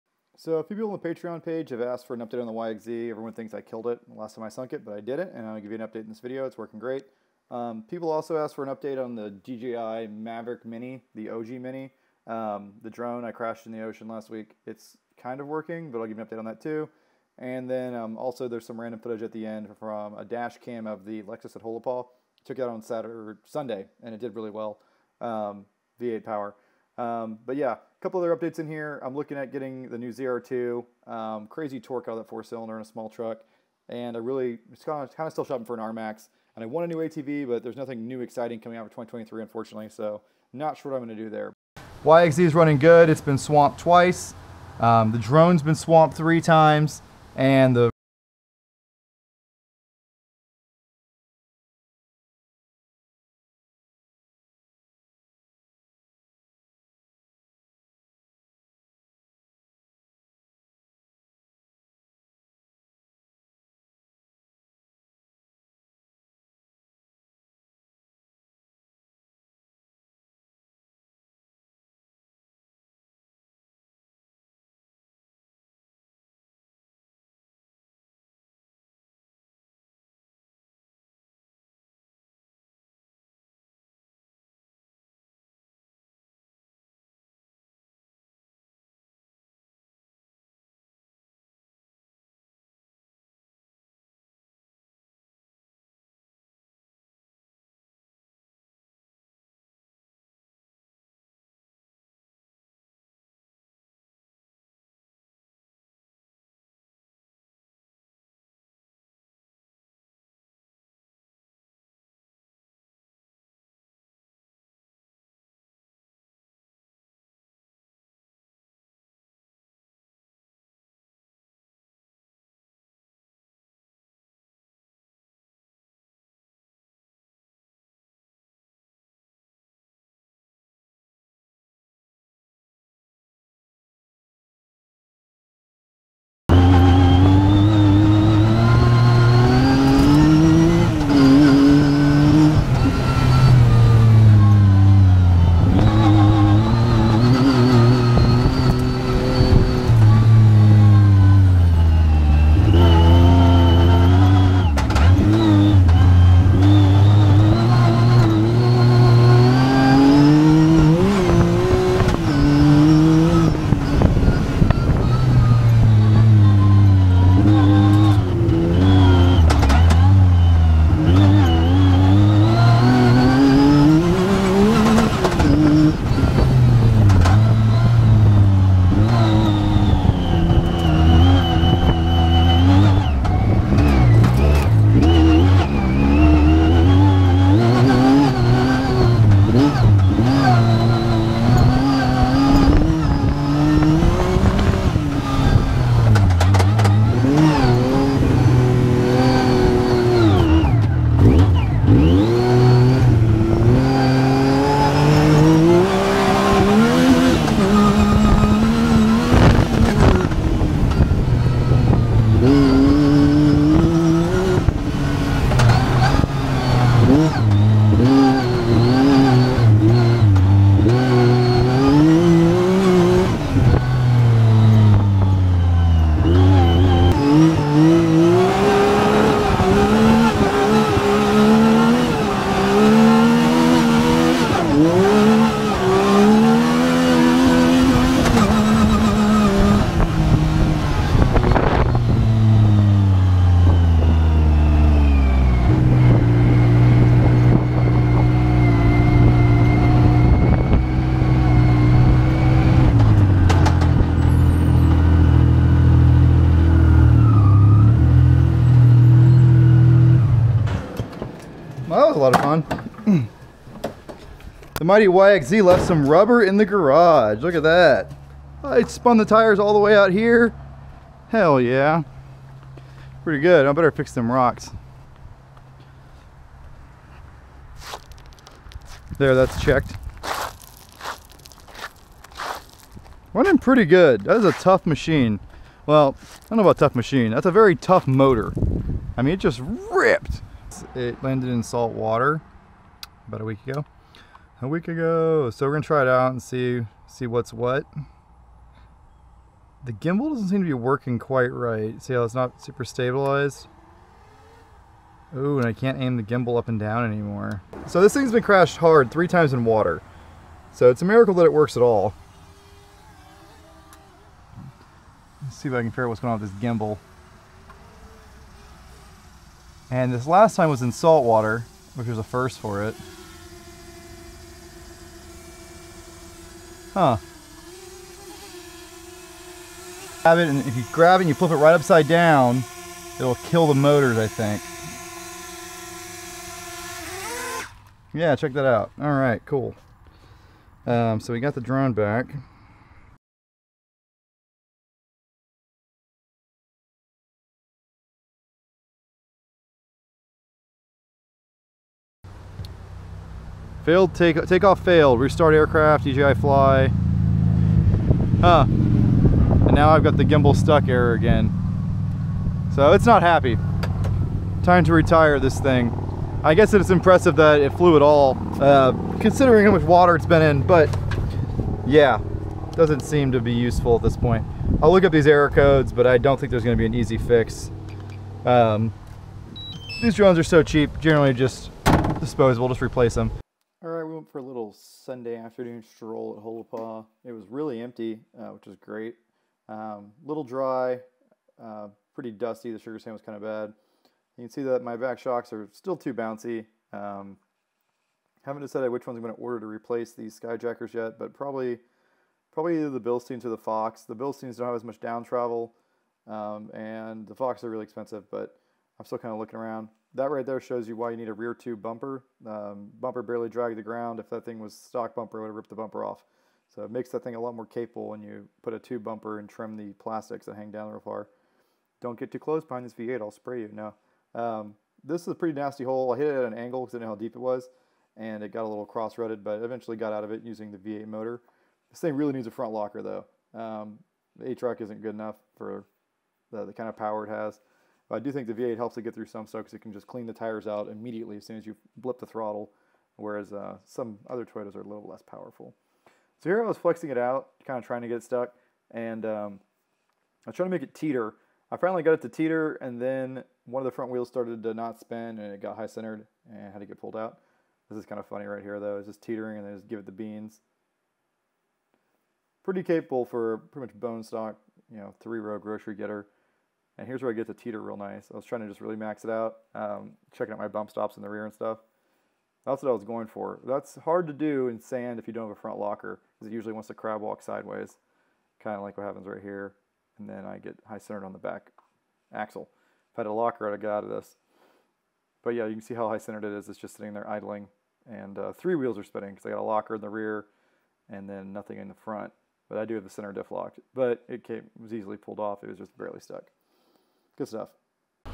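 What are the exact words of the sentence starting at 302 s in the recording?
See how it's not super stabilized?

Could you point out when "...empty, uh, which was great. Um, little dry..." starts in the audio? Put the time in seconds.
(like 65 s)
387 s.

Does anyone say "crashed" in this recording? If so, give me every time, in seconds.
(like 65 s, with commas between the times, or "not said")
13 s, 308 s.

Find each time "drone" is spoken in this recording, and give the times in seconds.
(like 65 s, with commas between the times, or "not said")
12 s, 45 s, 341 s, 380 s.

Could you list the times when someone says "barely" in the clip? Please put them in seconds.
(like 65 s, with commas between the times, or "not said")
413 s, 495 s.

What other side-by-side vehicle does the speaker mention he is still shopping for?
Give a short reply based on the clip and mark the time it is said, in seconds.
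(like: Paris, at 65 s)
RMAX, at 35 s.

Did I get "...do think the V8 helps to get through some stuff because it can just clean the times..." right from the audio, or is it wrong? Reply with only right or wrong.
wrong.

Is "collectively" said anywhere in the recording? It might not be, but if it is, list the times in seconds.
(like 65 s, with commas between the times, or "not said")
not said.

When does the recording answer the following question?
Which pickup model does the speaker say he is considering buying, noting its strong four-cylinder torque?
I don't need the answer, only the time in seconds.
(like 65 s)
30 s.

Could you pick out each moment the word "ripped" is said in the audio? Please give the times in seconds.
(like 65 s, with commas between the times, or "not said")
289 s, 415 s.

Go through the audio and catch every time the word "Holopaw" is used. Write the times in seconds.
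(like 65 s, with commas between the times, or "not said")
21 s, 386 s.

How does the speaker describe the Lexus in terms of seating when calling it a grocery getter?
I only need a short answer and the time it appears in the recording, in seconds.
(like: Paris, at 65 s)
three-row, at 465 s.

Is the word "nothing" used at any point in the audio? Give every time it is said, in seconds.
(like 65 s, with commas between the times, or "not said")
37 s, 491 s.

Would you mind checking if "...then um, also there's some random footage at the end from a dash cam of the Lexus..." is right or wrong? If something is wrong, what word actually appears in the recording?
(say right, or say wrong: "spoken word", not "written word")
right.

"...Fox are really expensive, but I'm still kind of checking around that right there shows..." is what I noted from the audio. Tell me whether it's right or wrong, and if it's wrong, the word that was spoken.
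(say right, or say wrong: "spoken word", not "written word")
wrong: "looking", not "checking".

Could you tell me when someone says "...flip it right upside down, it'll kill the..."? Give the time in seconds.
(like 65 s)
331 s.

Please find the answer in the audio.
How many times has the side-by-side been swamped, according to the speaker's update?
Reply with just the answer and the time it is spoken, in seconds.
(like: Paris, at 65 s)
2, at 43 s.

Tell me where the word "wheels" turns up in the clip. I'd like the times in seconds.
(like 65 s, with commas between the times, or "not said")
454 s, 488 s.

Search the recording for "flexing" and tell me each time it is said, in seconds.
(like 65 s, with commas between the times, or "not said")
446 s.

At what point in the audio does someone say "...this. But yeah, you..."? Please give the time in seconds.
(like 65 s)
484 s.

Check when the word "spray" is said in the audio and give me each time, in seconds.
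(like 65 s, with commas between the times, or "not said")
423 s.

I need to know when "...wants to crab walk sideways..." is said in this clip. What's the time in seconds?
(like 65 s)
476 s.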